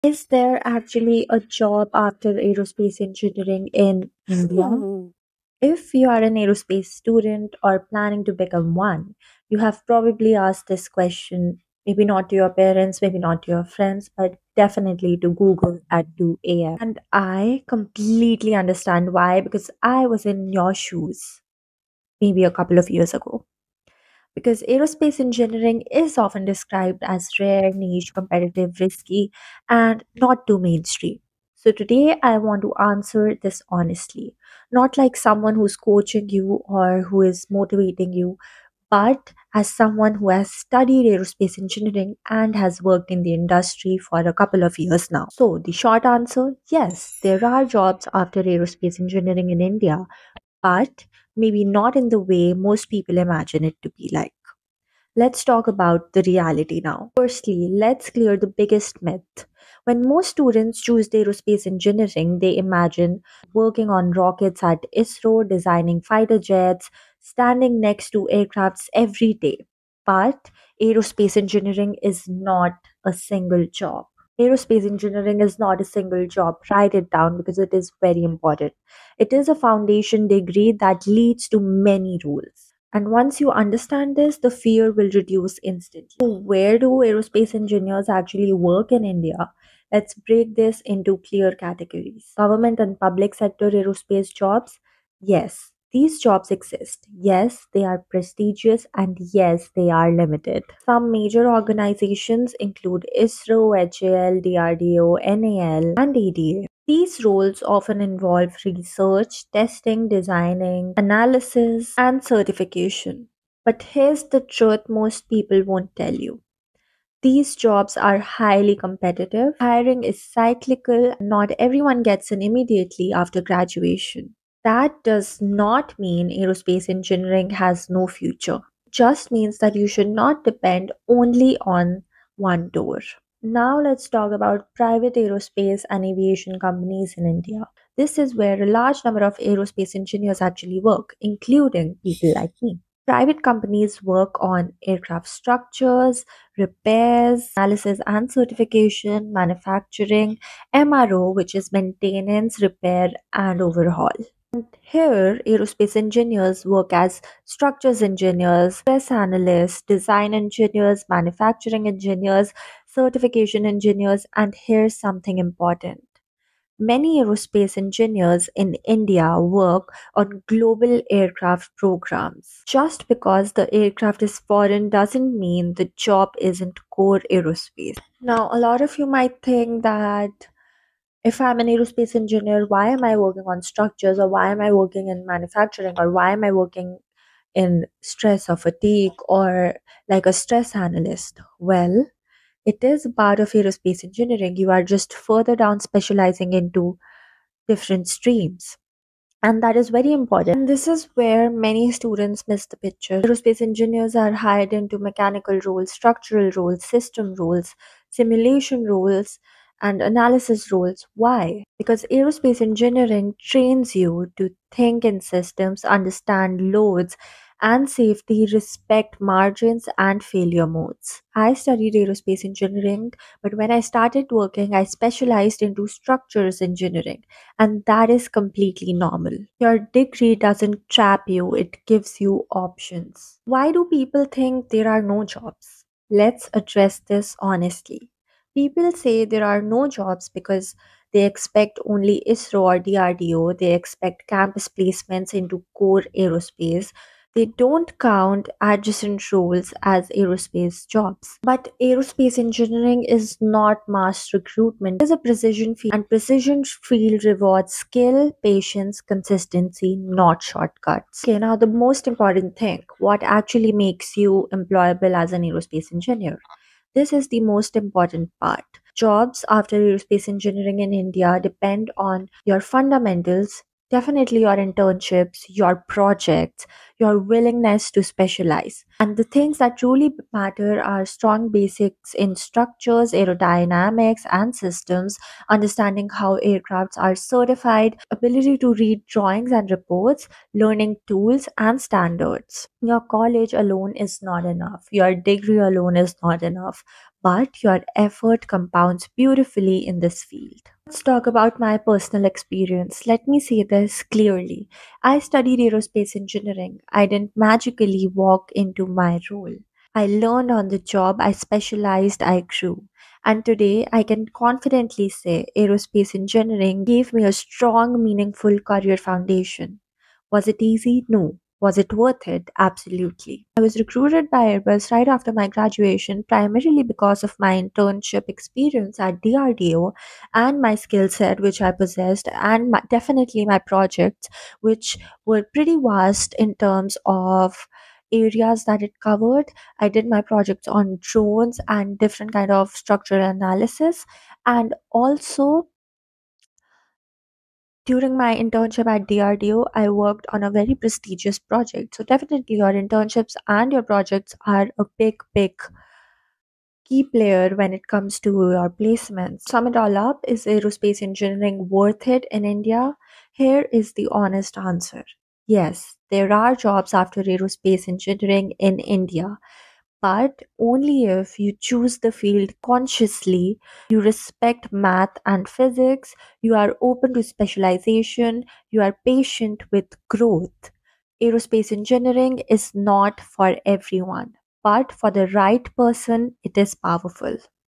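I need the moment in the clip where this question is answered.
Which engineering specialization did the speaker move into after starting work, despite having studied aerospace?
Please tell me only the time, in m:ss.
3:45.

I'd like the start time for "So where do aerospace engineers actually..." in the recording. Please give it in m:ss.
1:26.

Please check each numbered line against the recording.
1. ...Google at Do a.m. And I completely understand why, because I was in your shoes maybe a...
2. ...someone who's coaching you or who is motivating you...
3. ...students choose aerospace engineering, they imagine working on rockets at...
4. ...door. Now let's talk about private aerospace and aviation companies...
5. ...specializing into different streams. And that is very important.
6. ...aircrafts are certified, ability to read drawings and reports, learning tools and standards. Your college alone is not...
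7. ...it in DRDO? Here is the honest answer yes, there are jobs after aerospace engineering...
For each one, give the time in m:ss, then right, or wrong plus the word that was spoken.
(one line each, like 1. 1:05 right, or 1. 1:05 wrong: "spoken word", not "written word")
1. 0:15 right
2. 0:35 right
3. 1:00 right
4. 2:12 right
5. 3:15 right
6. 4:46 right
7. 6:02 wrong: "India", not "DRDO".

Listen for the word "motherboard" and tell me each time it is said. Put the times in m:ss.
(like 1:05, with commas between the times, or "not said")
not said.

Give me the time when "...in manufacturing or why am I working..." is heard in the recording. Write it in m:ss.
3:05.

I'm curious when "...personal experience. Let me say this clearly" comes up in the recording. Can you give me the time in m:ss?
5:01.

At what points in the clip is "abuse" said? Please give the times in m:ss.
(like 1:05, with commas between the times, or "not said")
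not said.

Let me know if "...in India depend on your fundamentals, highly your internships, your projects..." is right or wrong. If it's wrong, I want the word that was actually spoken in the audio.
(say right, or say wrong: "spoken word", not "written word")
wrong: "definitely", not "highly".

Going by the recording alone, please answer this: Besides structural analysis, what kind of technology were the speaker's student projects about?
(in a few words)
drones.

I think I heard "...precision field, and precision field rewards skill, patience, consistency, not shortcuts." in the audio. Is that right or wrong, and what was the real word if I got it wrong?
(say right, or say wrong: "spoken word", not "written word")
right.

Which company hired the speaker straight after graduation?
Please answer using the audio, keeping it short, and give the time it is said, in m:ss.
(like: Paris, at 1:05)
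Airbus, at 5:24.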